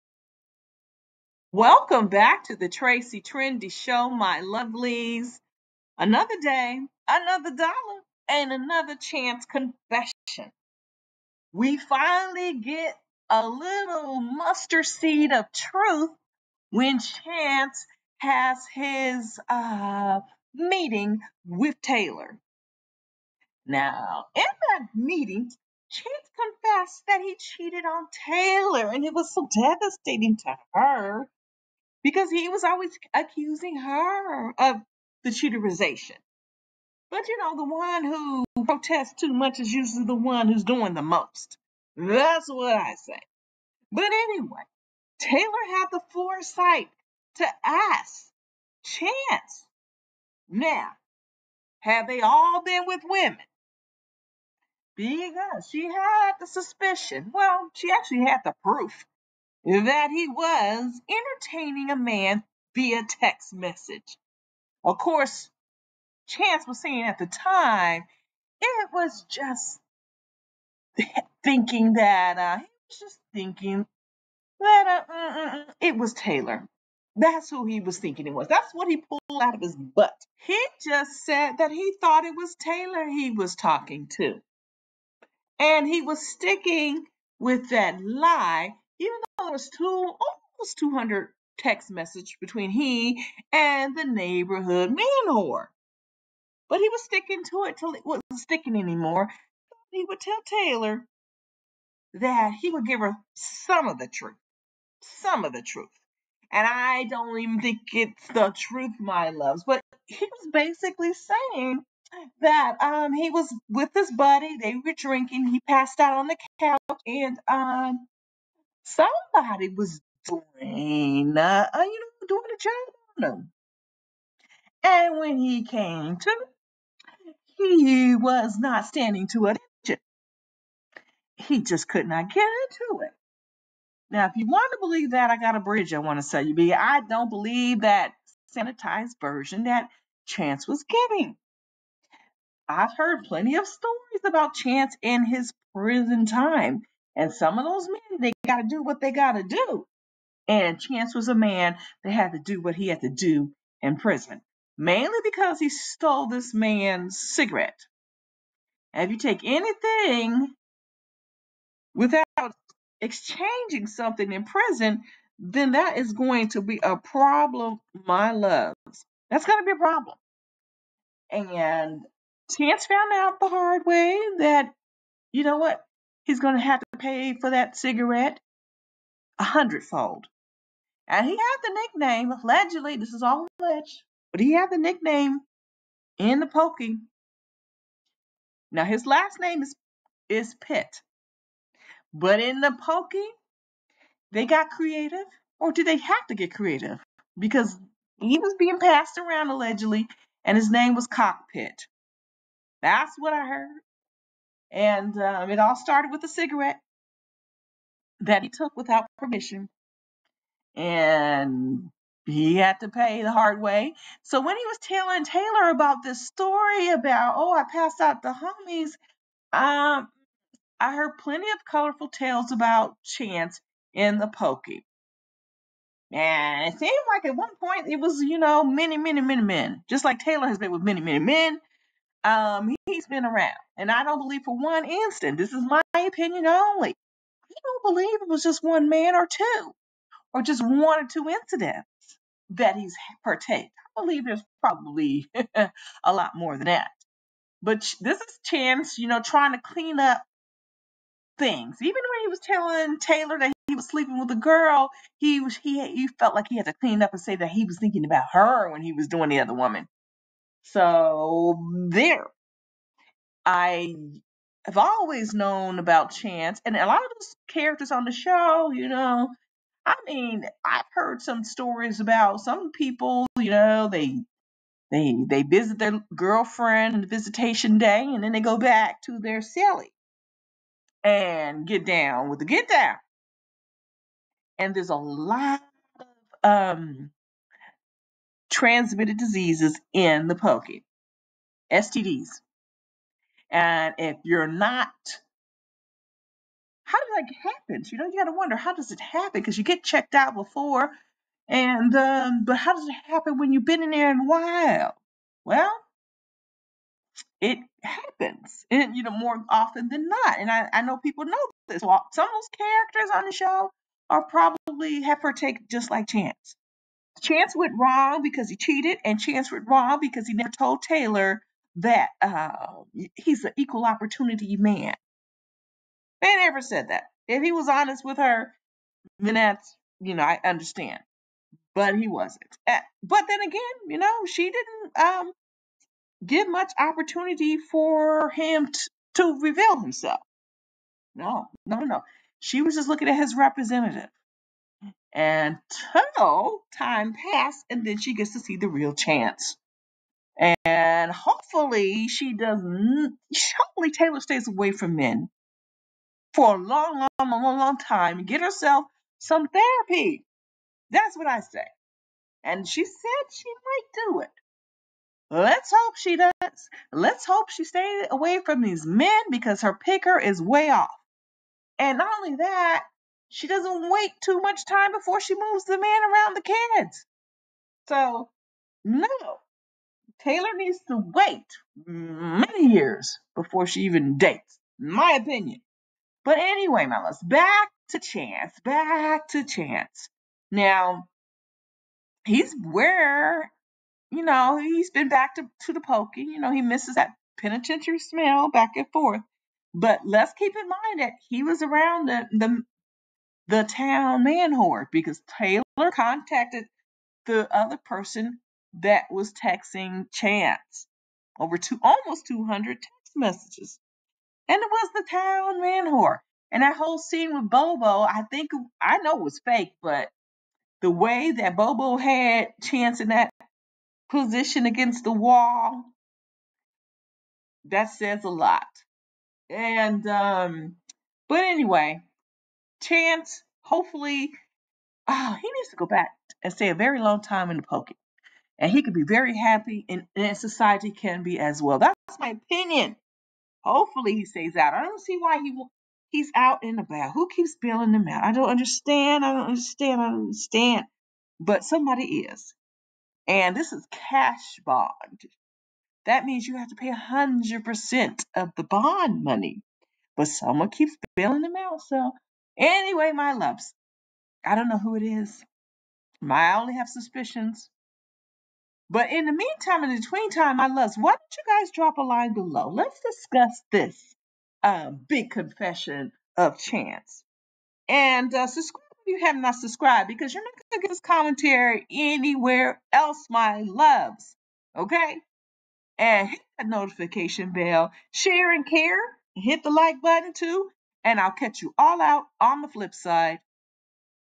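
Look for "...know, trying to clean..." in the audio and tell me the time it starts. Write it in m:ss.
4:09.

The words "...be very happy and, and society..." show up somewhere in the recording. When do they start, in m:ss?
7:18.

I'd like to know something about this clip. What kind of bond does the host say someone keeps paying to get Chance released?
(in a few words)
Cash bond.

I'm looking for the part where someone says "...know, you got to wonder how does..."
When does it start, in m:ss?
4:57.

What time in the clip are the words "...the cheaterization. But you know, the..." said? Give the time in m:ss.
0:35.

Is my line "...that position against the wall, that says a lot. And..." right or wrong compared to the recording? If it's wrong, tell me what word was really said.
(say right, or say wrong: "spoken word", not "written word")
right.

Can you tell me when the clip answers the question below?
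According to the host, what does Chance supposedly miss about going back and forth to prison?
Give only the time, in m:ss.
6:37.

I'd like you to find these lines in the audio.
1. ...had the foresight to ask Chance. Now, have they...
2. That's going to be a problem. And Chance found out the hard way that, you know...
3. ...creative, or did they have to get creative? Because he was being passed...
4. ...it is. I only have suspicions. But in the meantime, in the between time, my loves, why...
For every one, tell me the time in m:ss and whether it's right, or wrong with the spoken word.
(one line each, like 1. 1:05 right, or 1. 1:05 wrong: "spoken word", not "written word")
1. 0:45 right
2. 2:49 right
3. 3:14 right
4. 7:44 right.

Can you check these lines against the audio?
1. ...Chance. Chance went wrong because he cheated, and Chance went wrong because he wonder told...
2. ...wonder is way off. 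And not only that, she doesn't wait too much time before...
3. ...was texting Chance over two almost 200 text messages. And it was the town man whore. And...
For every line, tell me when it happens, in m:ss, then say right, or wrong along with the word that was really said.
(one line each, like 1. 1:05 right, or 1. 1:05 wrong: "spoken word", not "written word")
1. 5:16 wrong: "never", not "wonder"
2. 6:09 wrong: "picker", not "wonder"
3. 6:49 right.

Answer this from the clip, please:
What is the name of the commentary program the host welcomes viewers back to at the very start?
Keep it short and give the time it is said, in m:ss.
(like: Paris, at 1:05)
Tracie Trendy Show, at 0:02.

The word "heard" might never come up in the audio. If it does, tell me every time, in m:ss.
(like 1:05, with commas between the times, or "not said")
2:22, 3:23, 3:40, 4:30.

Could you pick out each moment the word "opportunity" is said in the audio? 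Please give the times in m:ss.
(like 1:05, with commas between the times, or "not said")
5:23, 5:36.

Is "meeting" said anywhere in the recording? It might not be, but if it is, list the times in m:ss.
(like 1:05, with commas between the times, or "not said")
0:20, 0:24.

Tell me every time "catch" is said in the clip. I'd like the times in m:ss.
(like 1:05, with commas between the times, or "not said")
8:11.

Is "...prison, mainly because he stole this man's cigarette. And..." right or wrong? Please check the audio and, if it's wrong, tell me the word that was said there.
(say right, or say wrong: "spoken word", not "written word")
right.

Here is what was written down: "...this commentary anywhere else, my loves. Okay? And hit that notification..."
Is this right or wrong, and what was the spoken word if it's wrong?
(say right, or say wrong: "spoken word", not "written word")
right.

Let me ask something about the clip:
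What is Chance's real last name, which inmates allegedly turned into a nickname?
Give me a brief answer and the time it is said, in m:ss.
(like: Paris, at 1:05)
Pitt, at 3:10.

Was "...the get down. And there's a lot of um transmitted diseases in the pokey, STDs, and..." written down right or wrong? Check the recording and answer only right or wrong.
right.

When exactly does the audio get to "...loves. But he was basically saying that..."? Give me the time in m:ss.
1:49.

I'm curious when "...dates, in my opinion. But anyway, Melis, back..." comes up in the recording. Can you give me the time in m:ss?
6:24.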